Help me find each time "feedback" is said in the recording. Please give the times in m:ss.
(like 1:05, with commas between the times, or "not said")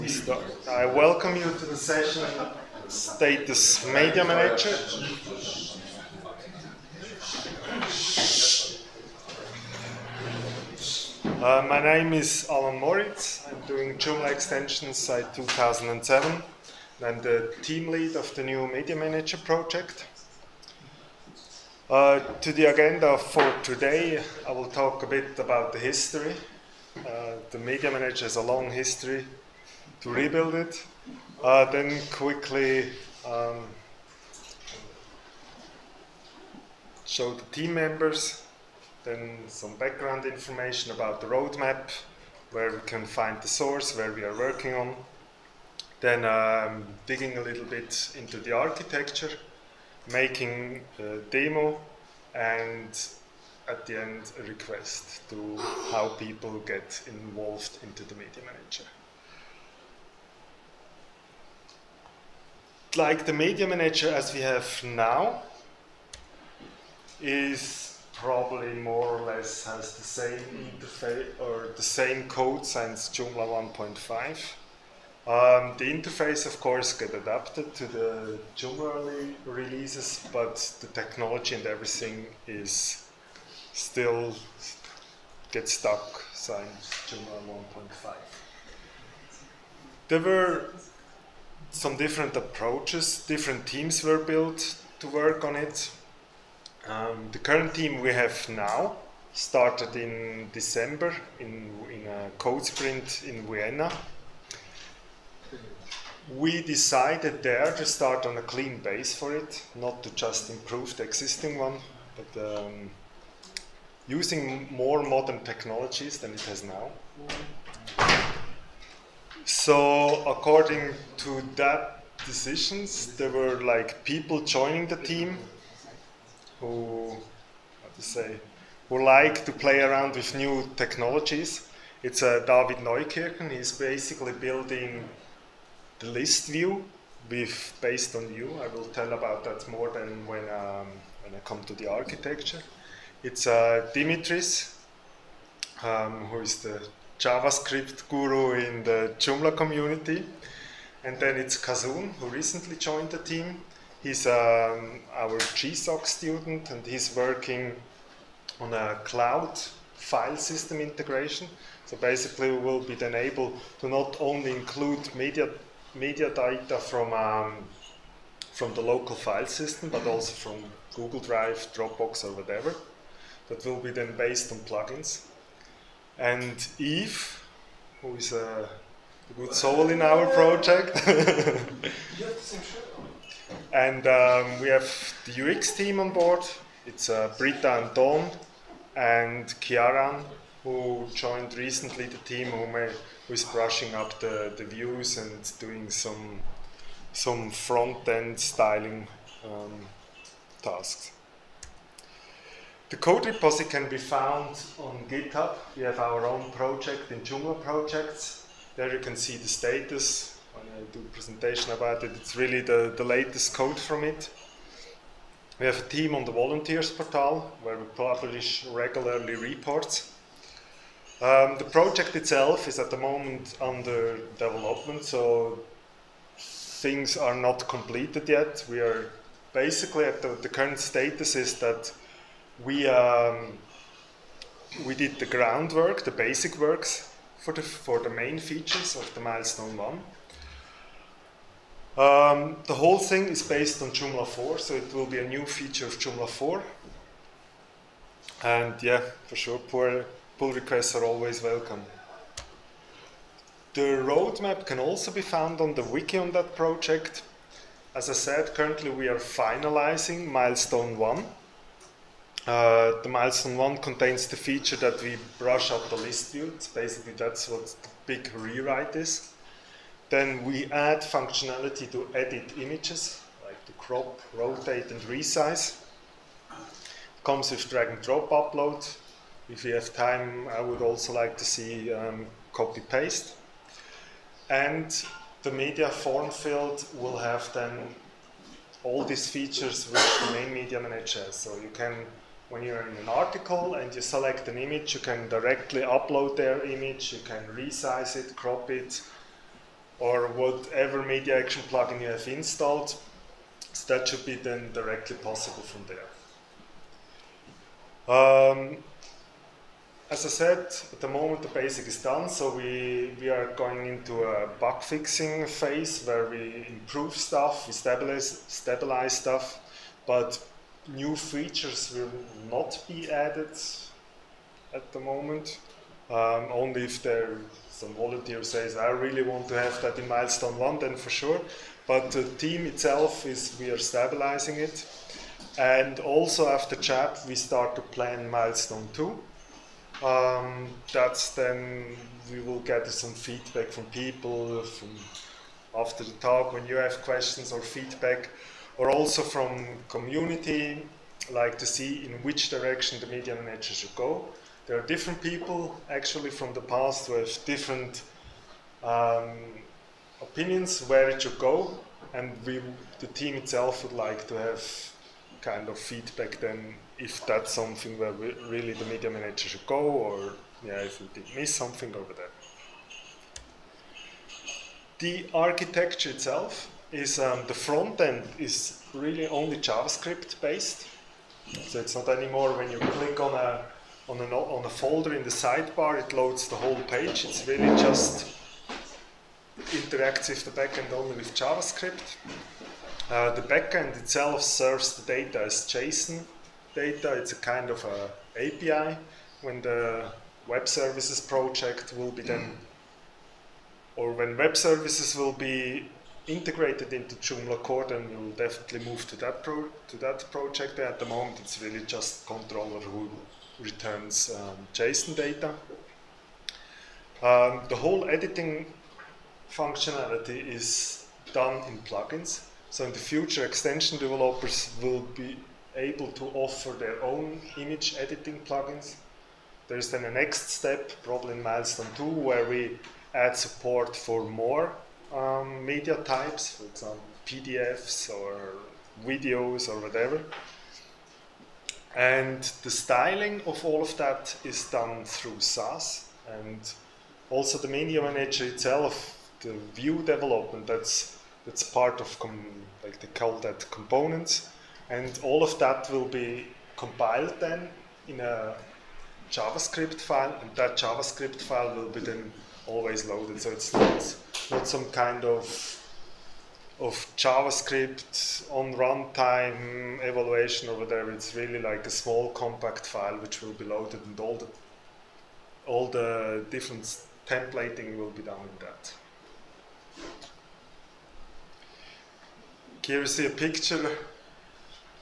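5:43, 5:47, 6:05.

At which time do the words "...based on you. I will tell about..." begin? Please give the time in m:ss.
2:17.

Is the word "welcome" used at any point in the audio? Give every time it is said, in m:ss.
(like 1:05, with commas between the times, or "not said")
0:00, 4:11.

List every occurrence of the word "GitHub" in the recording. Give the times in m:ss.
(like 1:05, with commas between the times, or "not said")
3:25.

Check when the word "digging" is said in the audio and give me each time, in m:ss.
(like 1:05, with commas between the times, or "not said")
0:47.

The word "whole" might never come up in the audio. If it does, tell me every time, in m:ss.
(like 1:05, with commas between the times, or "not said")
4:02, 6:26, 6:57.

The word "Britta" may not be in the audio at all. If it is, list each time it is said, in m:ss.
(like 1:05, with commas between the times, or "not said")
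3:07.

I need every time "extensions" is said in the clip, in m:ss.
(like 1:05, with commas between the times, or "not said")
0:14, 7:03.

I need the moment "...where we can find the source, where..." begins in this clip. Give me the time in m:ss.
0:42.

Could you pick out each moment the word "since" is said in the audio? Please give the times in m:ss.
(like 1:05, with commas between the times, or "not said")
1:12, 1:26.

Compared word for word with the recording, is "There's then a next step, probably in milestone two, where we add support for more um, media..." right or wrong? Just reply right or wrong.
right.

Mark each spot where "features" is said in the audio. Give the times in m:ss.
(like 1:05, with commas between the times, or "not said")
3:58, 4:05, 4:24, 4:49, 5:21.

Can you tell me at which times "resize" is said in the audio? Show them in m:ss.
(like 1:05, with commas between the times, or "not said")
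4:35, 4:57.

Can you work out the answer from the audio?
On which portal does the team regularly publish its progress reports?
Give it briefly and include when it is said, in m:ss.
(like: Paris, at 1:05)
volunteers portal, at 3:36.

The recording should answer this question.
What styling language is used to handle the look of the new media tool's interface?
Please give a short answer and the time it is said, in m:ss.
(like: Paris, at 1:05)
Sass, at 7:25.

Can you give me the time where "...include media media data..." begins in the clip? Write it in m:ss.
2:44.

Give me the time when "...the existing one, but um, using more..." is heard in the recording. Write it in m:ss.
1:50.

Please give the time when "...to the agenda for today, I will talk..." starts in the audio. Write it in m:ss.
0:22.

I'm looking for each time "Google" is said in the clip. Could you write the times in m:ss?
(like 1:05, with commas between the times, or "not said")
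2:50.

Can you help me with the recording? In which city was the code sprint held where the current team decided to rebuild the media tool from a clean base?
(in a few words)
Vienna.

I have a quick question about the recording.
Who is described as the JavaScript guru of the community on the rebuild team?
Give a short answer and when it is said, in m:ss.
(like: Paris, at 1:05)
Dimitris, at 2:23.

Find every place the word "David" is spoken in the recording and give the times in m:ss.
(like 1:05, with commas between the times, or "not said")
2:12.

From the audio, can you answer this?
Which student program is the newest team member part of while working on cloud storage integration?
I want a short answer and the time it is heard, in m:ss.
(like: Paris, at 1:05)
GSOC, at 2:35.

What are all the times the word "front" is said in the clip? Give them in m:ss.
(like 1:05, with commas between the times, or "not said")
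3:17, 6:17.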